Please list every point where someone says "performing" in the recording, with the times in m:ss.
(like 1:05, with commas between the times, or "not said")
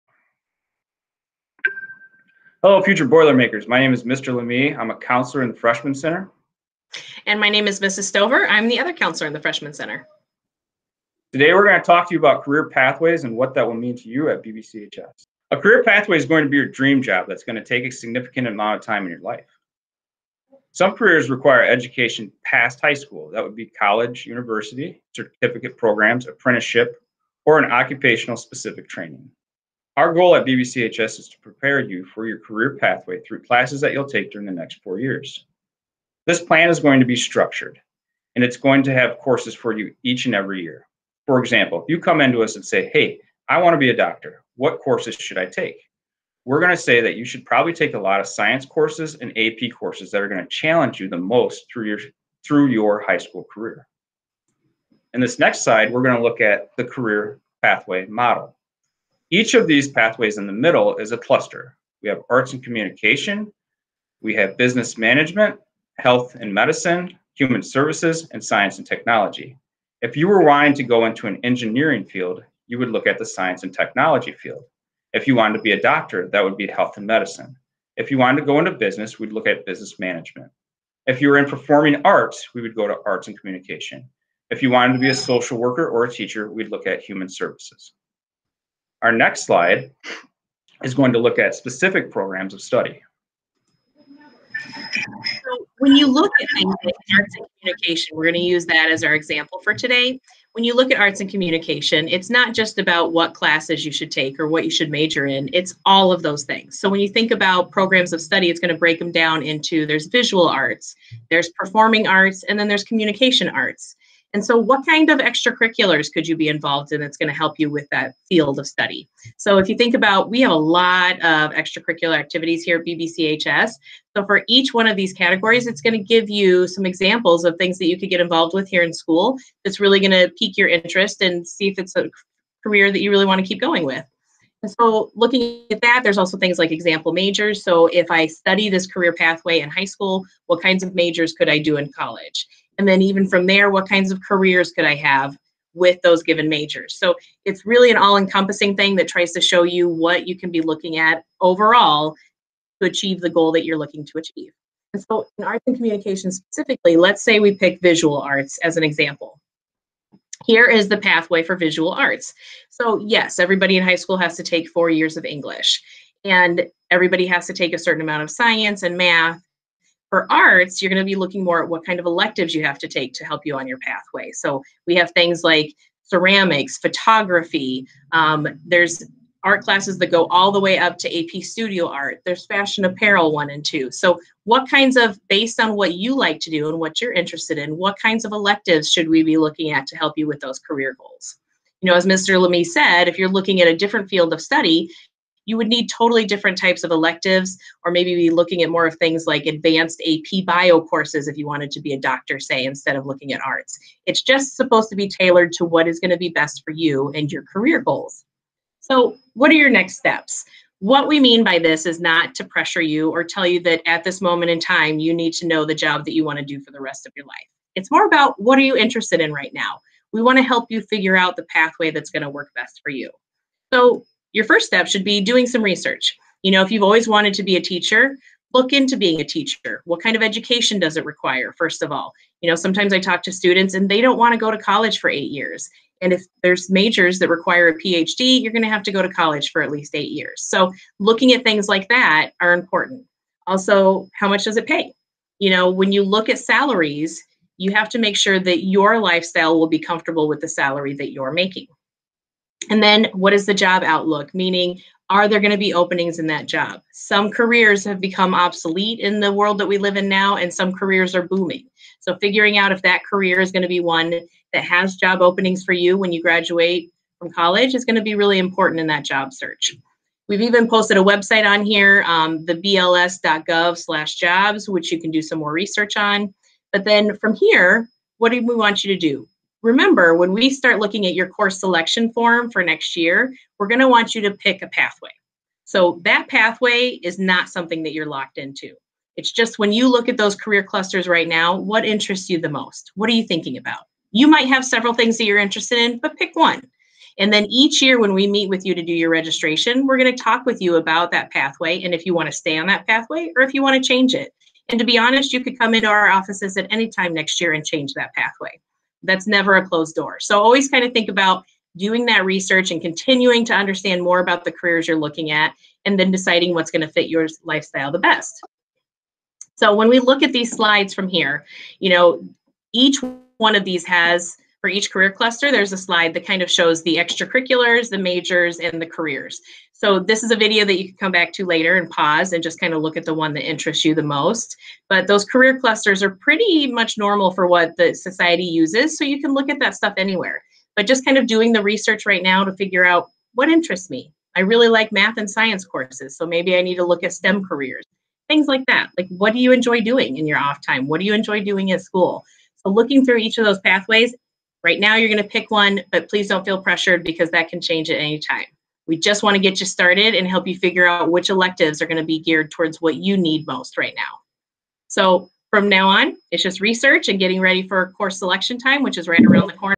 1:21, 1:51.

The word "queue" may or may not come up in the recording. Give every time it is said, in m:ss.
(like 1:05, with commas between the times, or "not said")
not said.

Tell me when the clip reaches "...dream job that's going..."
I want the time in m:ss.
0:16.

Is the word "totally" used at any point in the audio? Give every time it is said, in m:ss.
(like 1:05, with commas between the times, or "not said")
3:15.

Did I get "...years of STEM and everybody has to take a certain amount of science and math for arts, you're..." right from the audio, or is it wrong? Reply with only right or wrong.
wrong.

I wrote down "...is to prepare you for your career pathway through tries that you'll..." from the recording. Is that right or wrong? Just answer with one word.
wrong.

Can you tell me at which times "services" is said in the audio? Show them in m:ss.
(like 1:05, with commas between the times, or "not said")
1:07, 1:27.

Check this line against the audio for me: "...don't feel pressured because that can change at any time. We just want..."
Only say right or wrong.
right.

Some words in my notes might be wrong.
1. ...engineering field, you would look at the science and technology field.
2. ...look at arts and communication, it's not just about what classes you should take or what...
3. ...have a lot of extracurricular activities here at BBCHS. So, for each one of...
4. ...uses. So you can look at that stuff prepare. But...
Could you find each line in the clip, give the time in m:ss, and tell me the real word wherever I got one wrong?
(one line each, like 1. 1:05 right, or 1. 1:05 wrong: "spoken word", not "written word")
1. 1:11 right
2. 1:40 right
3. 2:00 right
4. 5:38 wrong: "anywhere", not "prepare".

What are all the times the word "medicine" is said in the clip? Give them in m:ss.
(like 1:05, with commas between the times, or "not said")
1:06, 1:17.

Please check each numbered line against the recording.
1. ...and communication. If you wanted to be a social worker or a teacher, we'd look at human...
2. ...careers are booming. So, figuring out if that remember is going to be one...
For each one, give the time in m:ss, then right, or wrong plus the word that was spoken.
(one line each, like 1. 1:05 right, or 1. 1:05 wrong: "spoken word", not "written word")
1. 1:23 right
2. 4:20 wrong: "career", not "remember".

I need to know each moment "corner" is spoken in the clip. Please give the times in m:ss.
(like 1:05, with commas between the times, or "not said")
6:09.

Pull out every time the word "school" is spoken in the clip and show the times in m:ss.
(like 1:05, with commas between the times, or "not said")
0:22, 0:53, 2:08, 2:19, 2:43, 5:51.